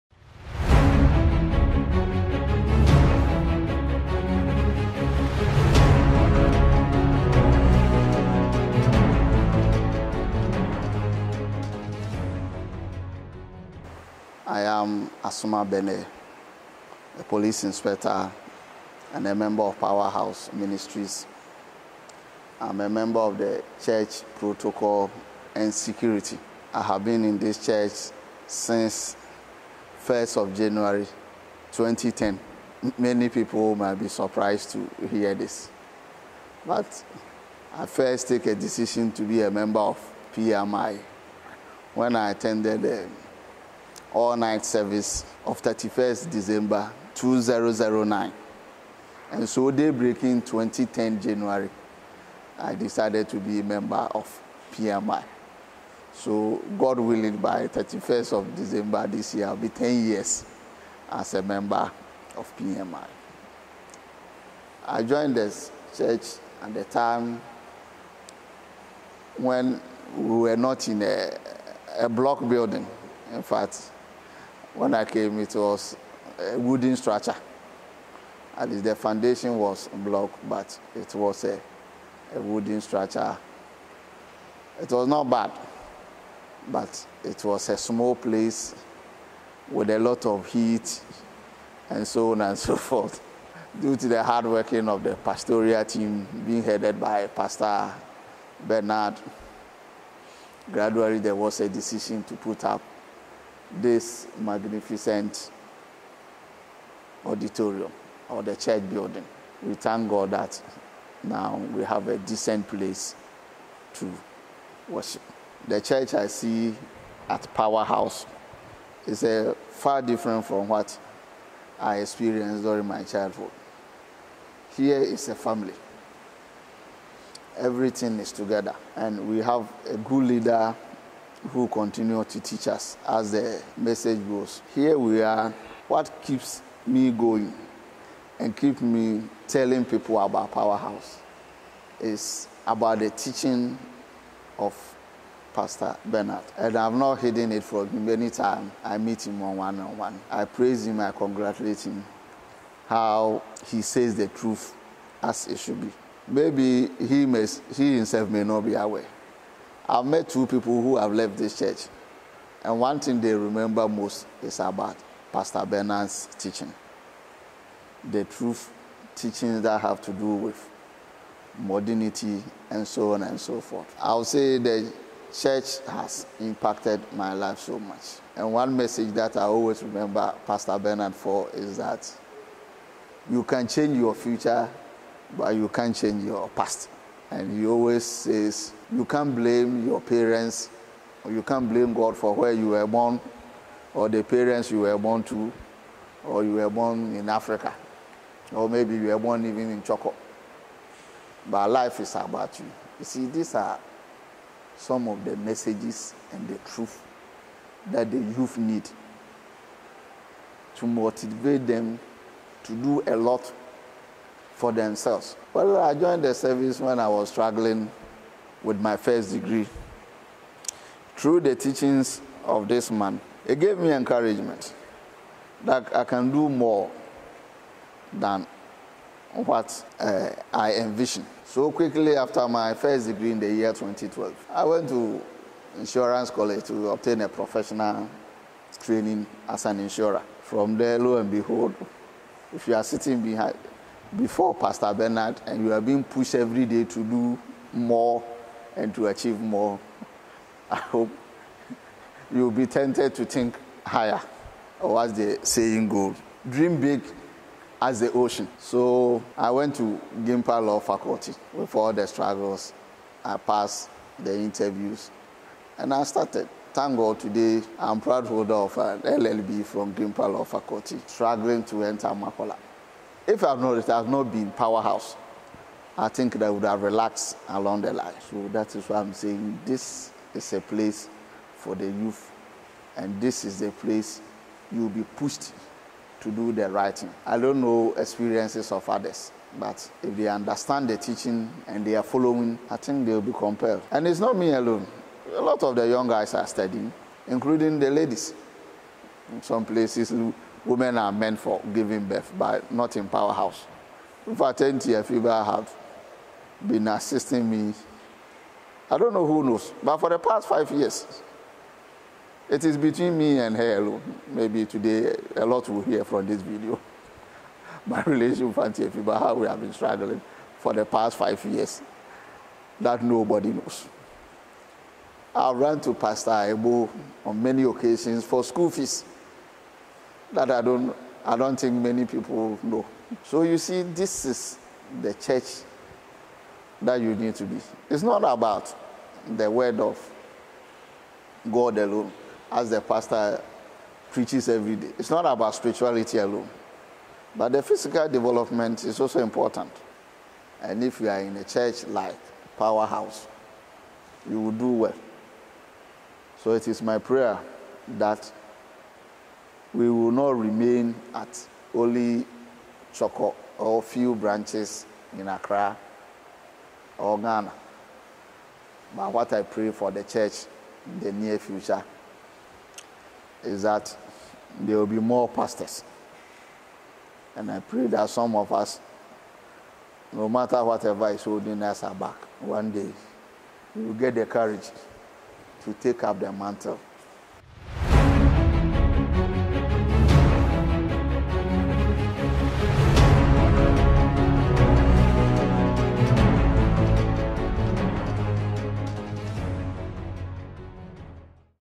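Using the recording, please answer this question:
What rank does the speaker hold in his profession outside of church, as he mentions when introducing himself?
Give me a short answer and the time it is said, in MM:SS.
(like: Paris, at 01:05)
Police inspector, at 00:17.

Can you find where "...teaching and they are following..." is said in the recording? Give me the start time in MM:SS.
04:50.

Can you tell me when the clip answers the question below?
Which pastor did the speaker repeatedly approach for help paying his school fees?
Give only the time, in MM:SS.
05:25.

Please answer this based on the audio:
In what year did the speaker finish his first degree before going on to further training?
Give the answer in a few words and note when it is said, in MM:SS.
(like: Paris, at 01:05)
2012, at 03:53.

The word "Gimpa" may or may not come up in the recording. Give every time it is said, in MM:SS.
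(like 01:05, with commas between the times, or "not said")
04:20, 04:29.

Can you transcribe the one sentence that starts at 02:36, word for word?
Maybe he, may, he himself may not be aware.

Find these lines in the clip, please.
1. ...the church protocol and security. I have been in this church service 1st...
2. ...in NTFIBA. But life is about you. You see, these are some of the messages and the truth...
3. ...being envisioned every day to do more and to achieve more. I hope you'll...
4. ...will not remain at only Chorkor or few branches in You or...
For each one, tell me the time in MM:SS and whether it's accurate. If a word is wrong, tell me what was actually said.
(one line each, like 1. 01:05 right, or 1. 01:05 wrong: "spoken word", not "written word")
1. 00:23 wrong: "since", not "service"
2. 03:19 wrong: "Choco", not "NTFIBA"
3. 04:05 wrong: "pushed", not "envisioned"
4. 05:59 wrong: "Accra", not "You".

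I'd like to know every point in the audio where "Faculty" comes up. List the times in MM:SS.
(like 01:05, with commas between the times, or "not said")
04:20, 04:30.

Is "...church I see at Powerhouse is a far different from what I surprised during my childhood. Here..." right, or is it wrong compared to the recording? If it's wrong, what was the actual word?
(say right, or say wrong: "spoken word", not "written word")
wrong: "experienced", not "surprised".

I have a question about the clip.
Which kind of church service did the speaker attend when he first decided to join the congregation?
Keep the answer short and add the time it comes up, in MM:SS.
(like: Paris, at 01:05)
All-night service, at 00:44.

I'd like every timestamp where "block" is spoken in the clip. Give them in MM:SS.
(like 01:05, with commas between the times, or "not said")
01:12, 01:19.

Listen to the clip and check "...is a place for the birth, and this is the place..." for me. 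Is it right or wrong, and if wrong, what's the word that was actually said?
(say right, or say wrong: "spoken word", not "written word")
wrong: "youth", not "birth".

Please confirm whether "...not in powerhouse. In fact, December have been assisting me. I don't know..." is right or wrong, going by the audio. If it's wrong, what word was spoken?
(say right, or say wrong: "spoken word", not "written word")
wrong: "NTFIBA", not "December".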